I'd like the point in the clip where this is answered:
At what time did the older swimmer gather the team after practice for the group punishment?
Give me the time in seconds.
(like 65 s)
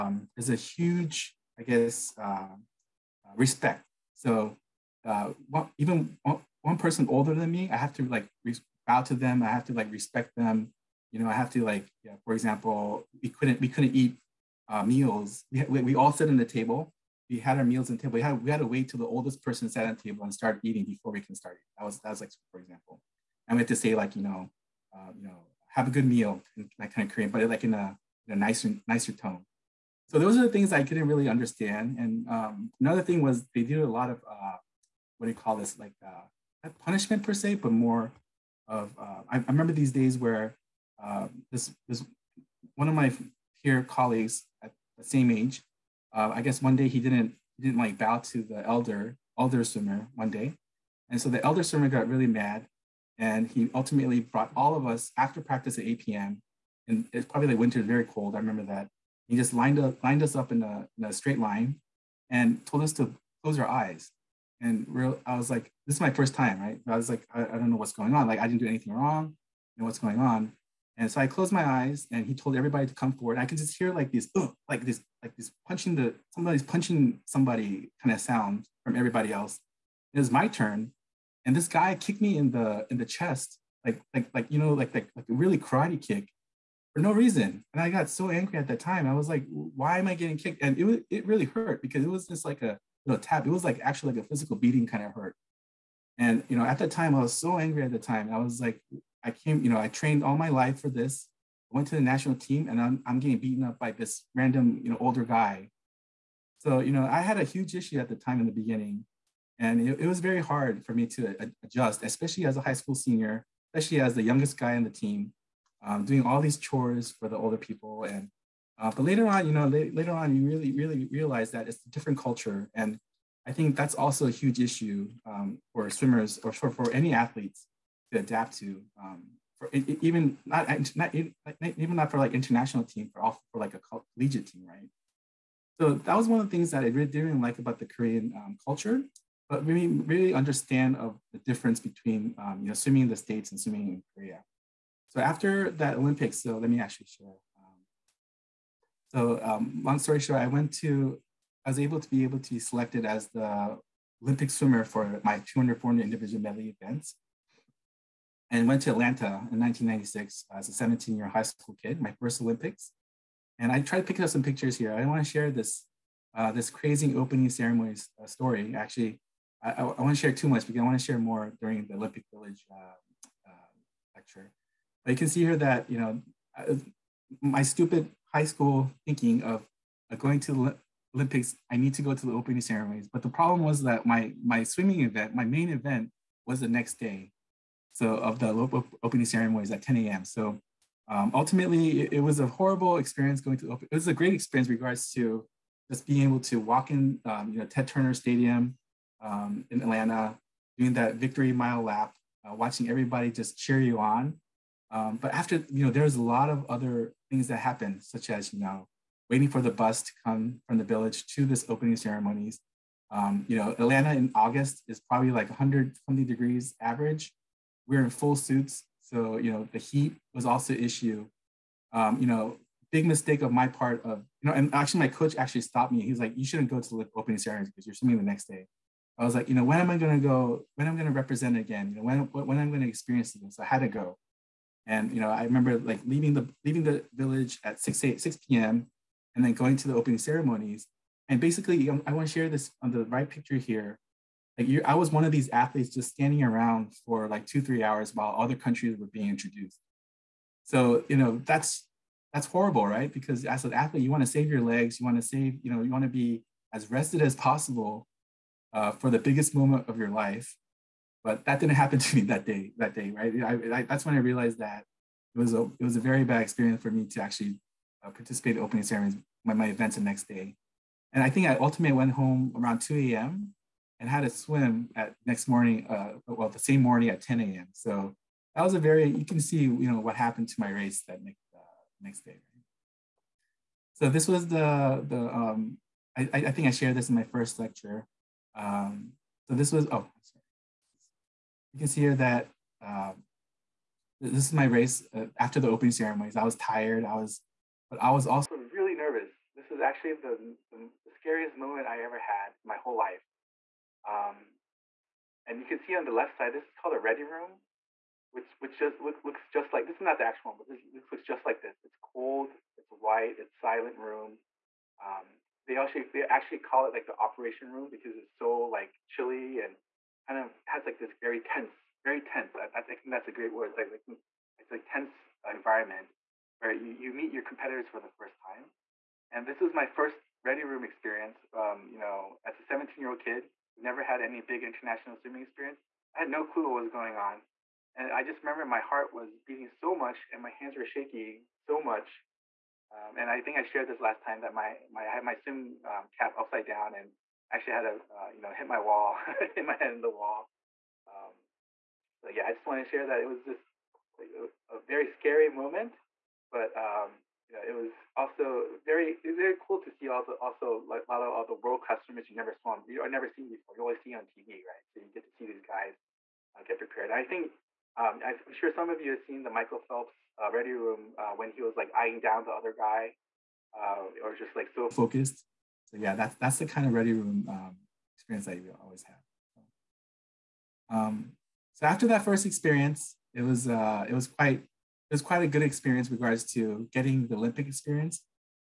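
55 s.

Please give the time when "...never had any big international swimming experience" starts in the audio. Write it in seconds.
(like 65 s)
333 s.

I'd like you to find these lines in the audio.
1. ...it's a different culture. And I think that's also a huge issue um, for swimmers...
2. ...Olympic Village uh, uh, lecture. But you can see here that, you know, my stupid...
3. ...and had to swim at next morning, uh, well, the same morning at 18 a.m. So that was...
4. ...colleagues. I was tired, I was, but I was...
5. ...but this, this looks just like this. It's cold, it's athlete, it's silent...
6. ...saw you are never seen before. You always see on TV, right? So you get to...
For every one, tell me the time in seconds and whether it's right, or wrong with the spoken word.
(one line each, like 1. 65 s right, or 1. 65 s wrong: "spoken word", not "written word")
1. 121 s right
2. 171 s right
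3. 274 s wrong: "10", not "18"
4. 295 s wrong: "ceremonies", not "colleagues"
5. 310 s wrong: "white", not "athlete"
6. 362 s right.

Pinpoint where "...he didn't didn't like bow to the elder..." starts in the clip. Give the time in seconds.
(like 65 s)
46 s.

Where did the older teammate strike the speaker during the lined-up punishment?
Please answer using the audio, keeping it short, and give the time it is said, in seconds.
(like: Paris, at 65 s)
In the chest, at 82 s.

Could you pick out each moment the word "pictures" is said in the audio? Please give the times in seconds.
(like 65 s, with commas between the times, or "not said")
164 s, 243 s.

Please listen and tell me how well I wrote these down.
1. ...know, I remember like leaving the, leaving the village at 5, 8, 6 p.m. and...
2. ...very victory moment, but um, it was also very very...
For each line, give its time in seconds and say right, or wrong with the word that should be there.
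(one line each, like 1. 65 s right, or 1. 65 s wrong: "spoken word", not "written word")
1. 235 s wrong: "6", not "5"
2. 354 s wrong: "scary", not "victory".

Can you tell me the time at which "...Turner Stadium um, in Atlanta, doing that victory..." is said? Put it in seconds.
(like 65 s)
197 s.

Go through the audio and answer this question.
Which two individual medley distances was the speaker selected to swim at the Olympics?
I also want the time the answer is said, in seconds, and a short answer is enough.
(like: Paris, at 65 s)
200 and 400, at 155 s.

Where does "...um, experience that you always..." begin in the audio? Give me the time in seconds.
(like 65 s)
377 s.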